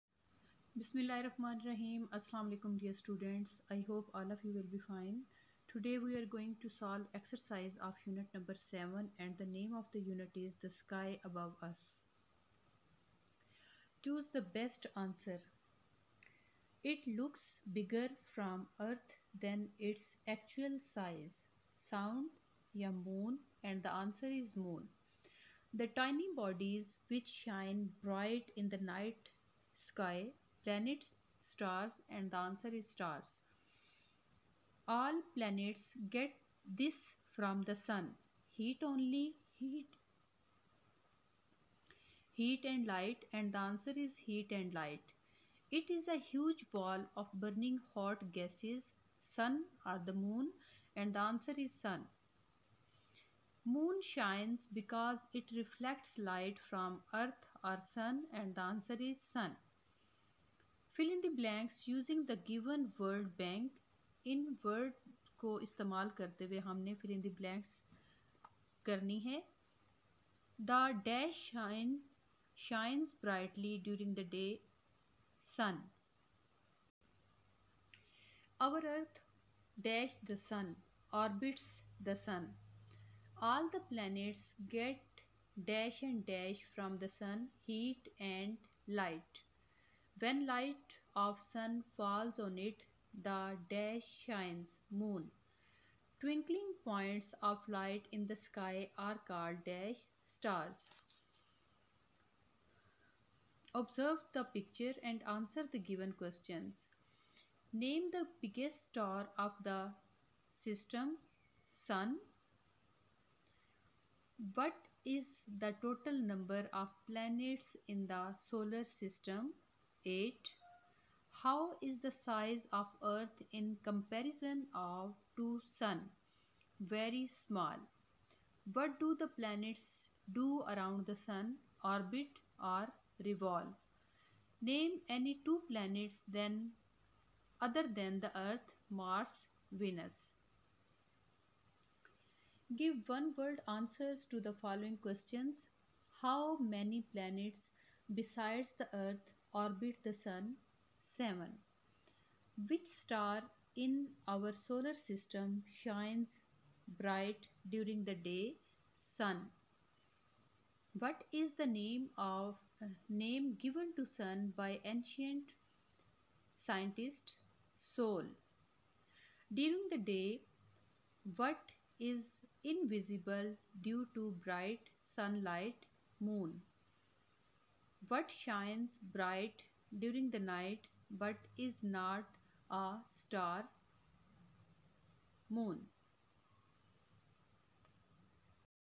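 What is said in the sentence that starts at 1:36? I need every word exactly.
Twinkling points of light in the sky are called dash stars.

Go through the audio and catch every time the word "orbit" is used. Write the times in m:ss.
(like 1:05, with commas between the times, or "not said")
2:11, 2:29.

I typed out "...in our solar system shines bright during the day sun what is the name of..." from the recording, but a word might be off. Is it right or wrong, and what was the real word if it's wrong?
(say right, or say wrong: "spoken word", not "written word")
right.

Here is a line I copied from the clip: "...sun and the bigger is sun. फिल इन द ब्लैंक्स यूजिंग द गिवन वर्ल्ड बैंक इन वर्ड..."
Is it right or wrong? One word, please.
wrong.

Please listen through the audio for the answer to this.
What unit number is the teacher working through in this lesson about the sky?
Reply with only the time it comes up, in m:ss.
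0:08.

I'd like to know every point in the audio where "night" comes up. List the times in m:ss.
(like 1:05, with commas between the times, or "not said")
0:28, 3:00.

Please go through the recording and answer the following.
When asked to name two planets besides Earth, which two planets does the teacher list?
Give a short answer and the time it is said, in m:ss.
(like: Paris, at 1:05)
Mars, Venus, at 2:18.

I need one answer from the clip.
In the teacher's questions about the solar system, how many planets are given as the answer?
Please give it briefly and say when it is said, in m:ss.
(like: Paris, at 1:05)
8, at 2:00.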